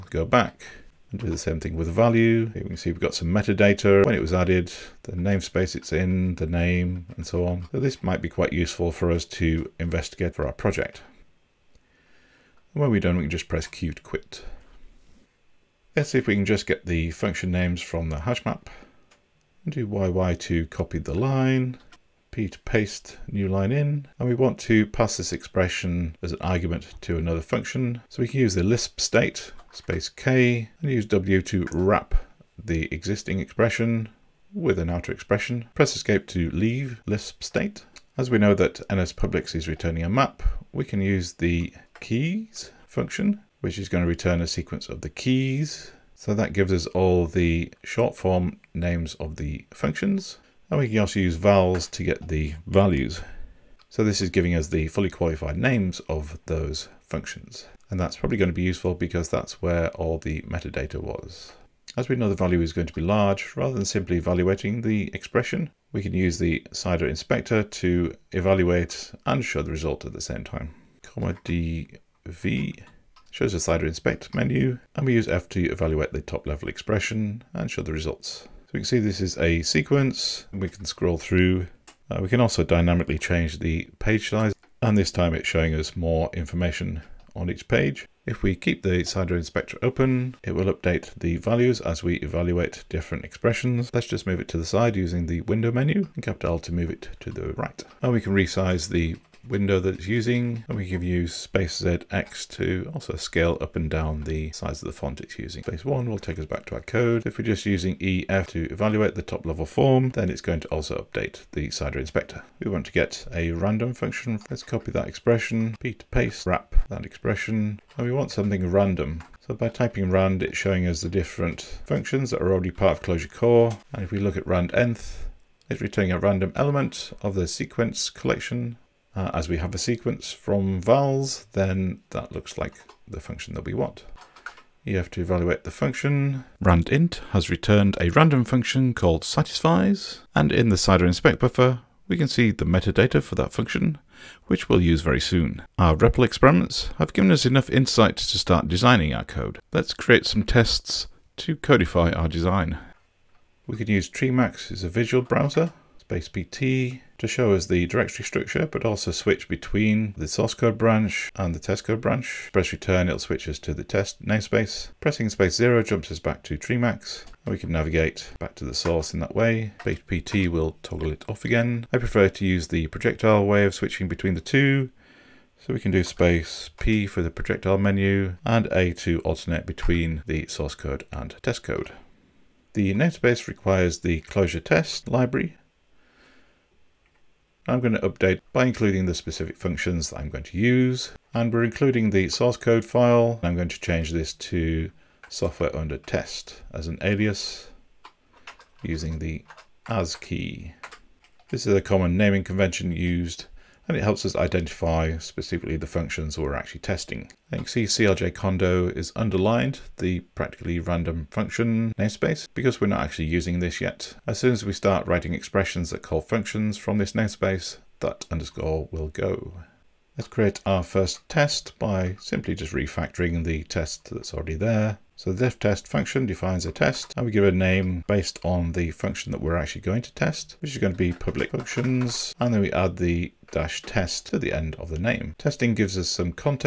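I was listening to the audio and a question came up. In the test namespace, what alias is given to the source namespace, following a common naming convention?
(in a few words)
software under test.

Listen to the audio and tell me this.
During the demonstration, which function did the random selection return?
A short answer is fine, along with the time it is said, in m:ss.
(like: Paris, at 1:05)
satisfies, at 2:19.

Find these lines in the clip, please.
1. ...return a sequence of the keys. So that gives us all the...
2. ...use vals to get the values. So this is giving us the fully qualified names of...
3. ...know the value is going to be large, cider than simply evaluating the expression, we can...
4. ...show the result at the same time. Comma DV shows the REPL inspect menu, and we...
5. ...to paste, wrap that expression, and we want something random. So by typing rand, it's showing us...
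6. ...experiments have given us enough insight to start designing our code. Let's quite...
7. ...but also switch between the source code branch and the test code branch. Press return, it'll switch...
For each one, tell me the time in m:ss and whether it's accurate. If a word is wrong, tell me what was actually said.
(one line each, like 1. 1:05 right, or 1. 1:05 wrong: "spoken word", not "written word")
1. 0:44 right
2. 0:51 right
3. 1:02 wrong: "rather", not "cider"
4. 1:09 wrong: "CIDER", not "REPL"
5. 1:55 right
6. 2:26 wrong: "create", not "quite"
7. 2:38 right.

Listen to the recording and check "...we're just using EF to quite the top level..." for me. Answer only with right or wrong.
wrong.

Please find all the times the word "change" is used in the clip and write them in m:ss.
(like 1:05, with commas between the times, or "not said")
1:23, 3:13.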